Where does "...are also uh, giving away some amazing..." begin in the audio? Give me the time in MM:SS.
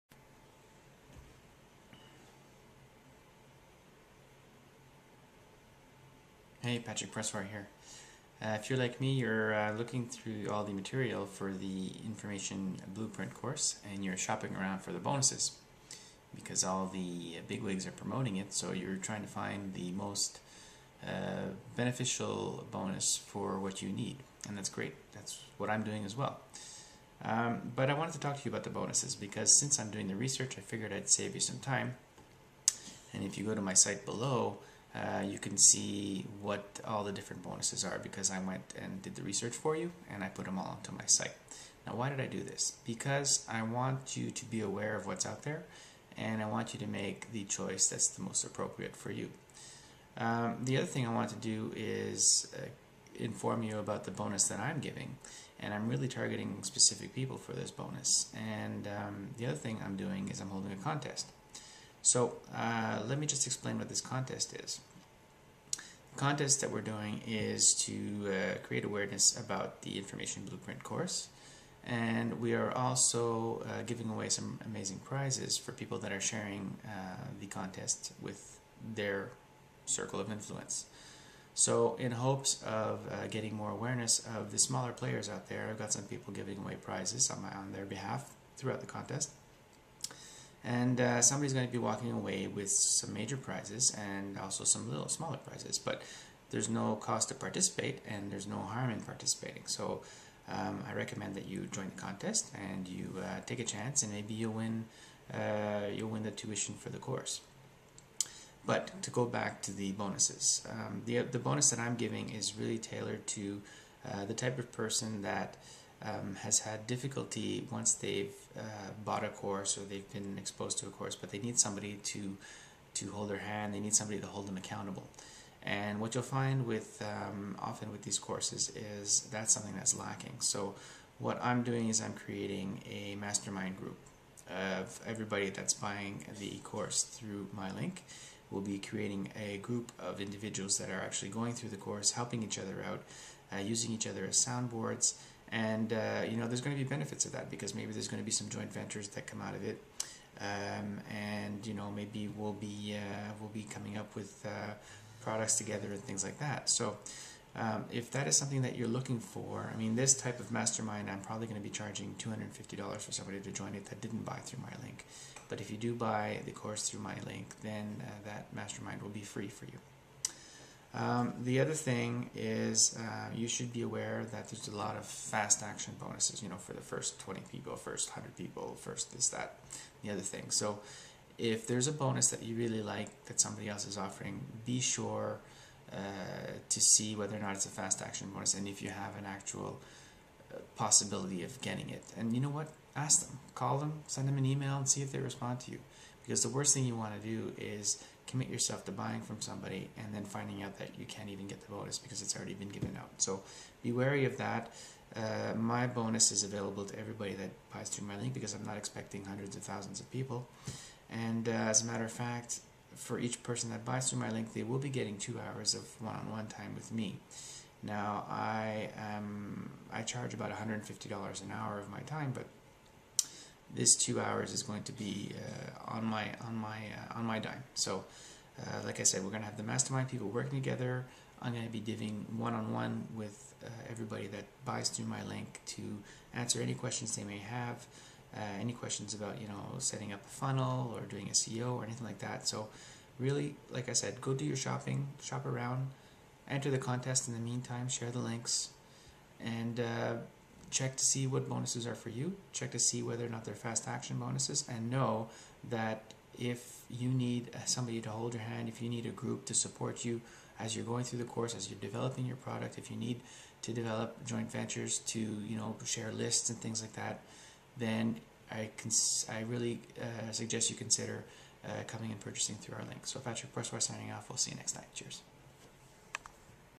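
01:12.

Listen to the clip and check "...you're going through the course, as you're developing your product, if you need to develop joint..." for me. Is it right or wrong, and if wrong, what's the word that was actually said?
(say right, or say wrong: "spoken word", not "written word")
right.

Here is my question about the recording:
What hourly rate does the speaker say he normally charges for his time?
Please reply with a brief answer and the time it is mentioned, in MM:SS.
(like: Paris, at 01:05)
$150, at 03:40.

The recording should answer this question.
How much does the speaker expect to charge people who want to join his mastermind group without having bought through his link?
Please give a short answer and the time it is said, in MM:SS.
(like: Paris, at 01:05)
$250, at 02:42.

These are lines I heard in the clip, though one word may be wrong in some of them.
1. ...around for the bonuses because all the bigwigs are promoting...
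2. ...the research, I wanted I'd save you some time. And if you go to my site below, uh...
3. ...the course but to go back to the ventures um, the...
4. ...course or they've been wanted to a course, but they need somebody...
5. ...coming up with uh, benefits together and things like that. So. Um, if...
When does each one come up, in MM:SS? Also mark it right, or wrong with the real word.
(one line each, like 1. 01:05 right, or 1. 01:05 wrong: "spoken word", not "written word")
1. 00:14 right
2. 00:30 wrong: "figured", not "wanted"
3. 01:46 wrong: "bonuses", not "ventures"
4. 01:59 wrong: "exposed", not "wanted"
5. 02:33 wrong: "products", not "benefits".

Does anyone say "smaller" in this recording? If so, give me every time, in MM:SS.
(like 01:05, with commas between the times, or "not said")
01:24, 01:35.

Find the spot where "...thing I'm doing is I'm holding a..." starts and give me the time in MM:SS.
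00:59.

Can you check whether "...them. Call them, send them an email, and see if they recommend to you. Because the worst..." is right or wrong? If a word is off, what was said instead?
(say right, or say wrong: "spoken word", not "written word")
wrong: "respond", not "recommend".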